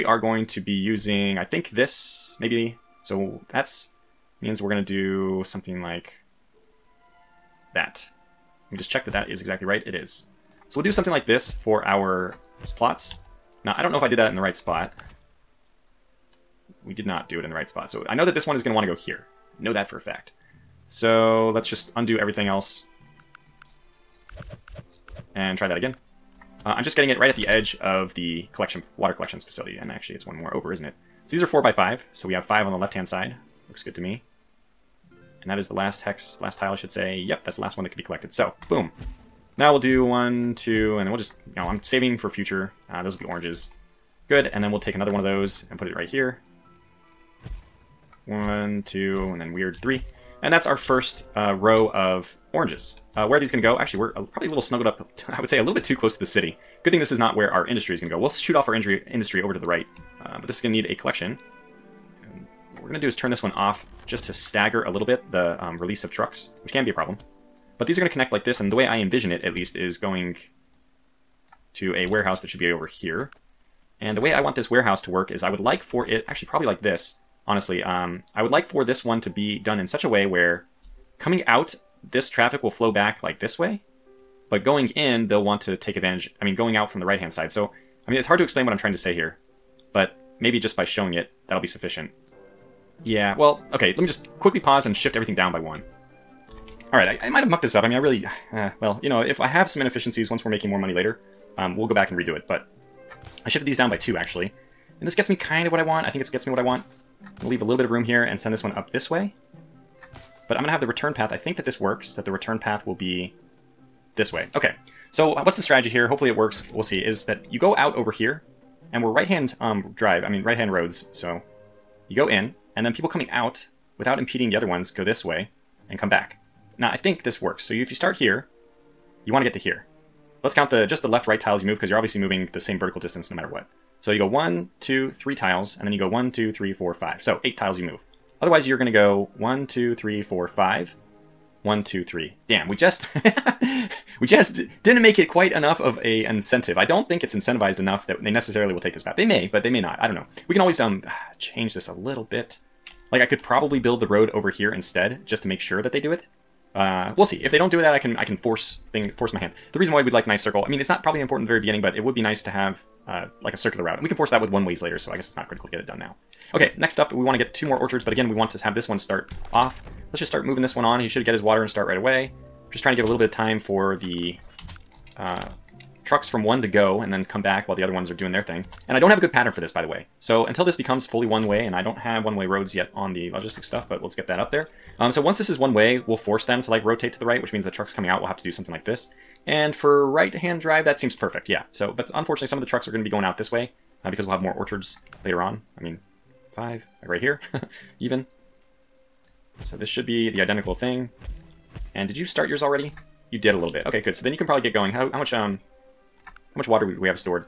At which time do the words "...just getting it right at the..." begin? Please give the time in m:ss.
0:26.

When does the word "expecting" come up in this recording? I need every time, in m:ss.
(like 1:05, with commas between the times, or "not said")
not said.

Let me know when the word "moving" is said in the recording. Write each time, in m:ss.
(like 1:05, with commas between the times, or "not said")
2:12, 2:50.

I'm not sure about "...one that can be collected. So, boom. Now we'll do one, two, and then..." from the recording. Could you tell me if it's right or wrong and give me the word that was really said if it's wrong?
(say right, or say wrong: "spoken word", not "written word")
right.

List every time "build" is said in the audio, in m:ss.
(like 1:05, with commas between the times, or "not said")
2:33.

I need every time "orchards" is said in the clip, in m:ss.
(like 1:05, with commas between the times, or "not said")
2:47, 3:14.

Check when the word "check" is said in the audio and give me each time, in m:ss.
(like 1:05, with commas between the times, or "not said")
0:08.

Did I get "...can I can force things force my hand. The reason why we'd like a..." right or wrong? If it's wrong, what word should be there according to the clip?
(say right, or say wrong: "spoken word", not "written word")
right.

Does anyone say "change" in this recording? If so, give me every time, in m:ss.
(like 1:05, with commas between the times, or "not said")
2:31.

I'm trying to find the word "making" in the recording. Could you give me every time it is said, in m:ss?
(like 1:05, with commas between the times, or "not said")
1:40.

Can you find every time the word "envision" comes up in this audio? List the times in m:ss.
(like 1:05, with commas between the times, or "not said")
1:08.